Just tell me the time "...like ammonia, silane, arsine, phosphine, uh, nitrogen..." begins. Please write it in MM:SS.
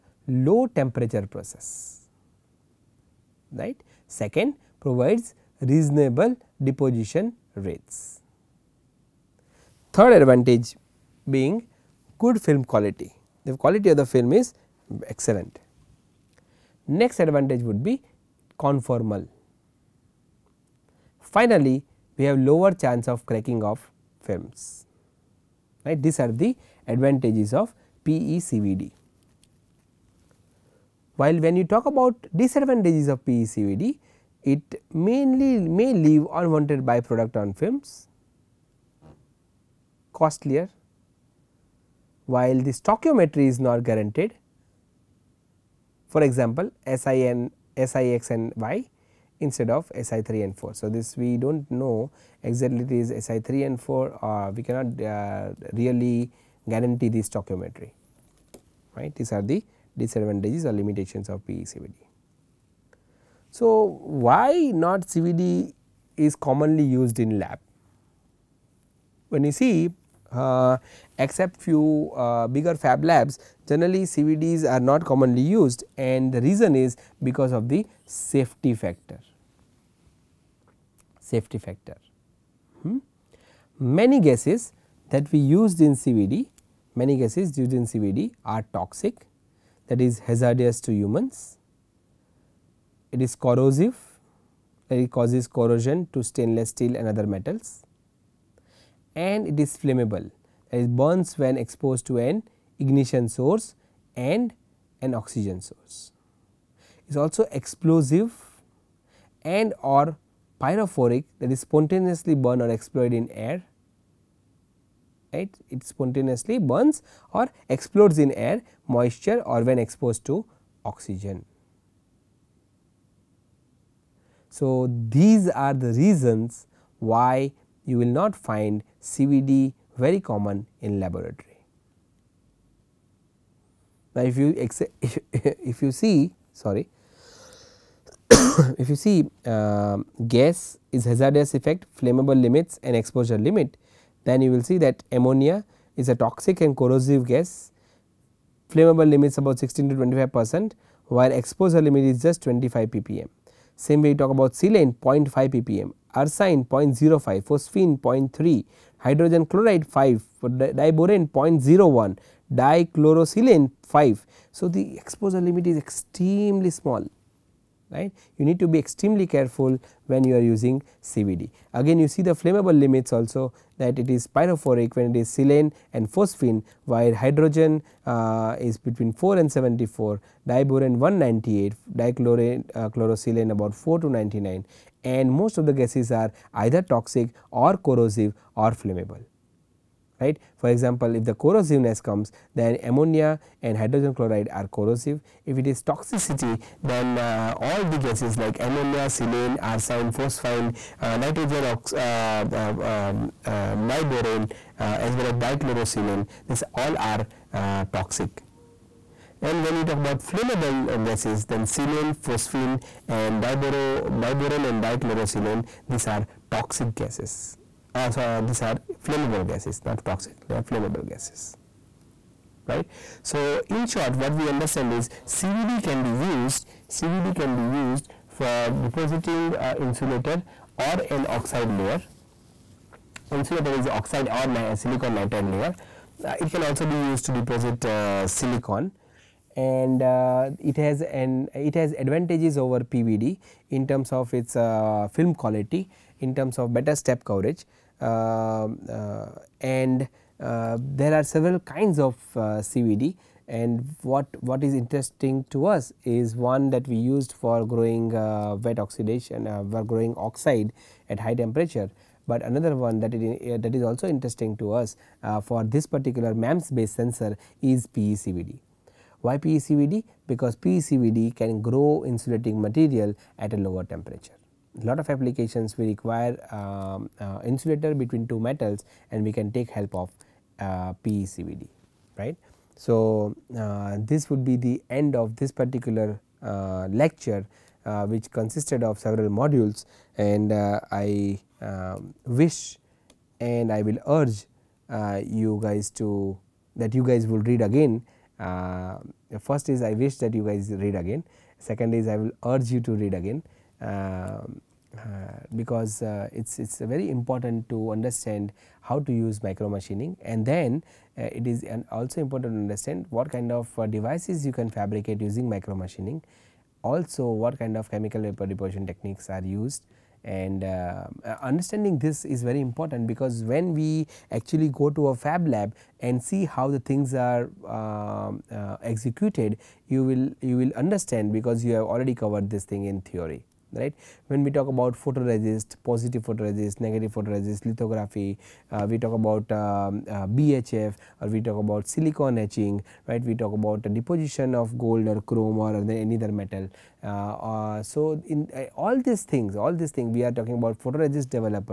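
03:18.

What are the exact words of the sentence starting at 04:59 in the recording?
first is I wish that you guys read again, second is I will urge you to read again.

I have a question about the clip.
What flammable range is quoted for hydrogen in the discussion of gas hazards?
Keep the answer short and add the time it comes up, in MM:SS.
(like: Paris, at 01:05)
4 to 74, at 02:58.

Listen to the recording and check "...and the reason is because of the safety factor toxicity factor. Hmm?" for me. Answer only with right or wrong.
wrong.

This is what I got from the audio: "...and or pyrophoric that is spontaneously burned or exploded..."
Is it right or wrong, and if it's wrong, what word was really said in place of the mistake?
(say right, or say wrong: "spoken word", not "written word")
right.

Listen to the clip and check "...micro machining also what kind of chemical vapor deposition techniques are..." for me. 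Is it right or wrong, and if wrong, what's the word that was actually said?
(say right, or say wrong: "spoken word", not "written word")
right.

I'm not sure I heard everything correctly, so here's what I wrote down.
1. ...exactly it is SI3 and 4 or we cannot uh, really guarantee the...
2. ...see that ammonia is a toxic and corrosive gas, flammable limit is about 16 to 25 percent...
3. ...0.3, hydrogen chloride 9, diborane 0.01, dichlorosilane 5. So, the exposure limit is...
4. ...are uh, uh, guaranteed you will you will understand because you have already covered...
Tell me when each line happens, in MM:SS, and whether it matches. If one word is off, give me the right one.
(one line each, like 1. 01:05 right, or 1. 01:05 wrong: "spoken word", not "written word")
1. 00:52 right
2. 02:24 right
3. 02:37 wrong: "5", not "9"
4. 05:27 wrong: "executed", not "guaranteed".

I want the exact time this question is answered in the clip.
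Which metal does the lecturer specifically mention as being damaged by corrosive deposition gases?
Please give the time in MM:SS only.
01:36.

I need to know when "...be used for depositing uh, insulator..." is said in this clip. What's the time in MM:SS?
03:47.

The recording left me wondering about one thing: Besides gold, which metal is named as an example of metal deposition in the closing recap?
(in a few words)
chrome.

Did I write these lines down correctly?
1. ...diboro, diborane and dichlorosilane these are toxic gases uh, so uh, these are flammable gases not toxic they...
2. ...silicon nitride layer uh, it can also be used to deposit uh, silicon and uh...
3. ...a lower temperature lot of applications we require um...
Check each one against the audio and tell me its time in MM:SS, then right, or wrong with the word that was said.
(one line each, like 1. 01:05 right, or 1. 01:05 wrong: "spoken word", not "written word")
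1. 03:33 right
2. 03:54 right
3. 04:33 right.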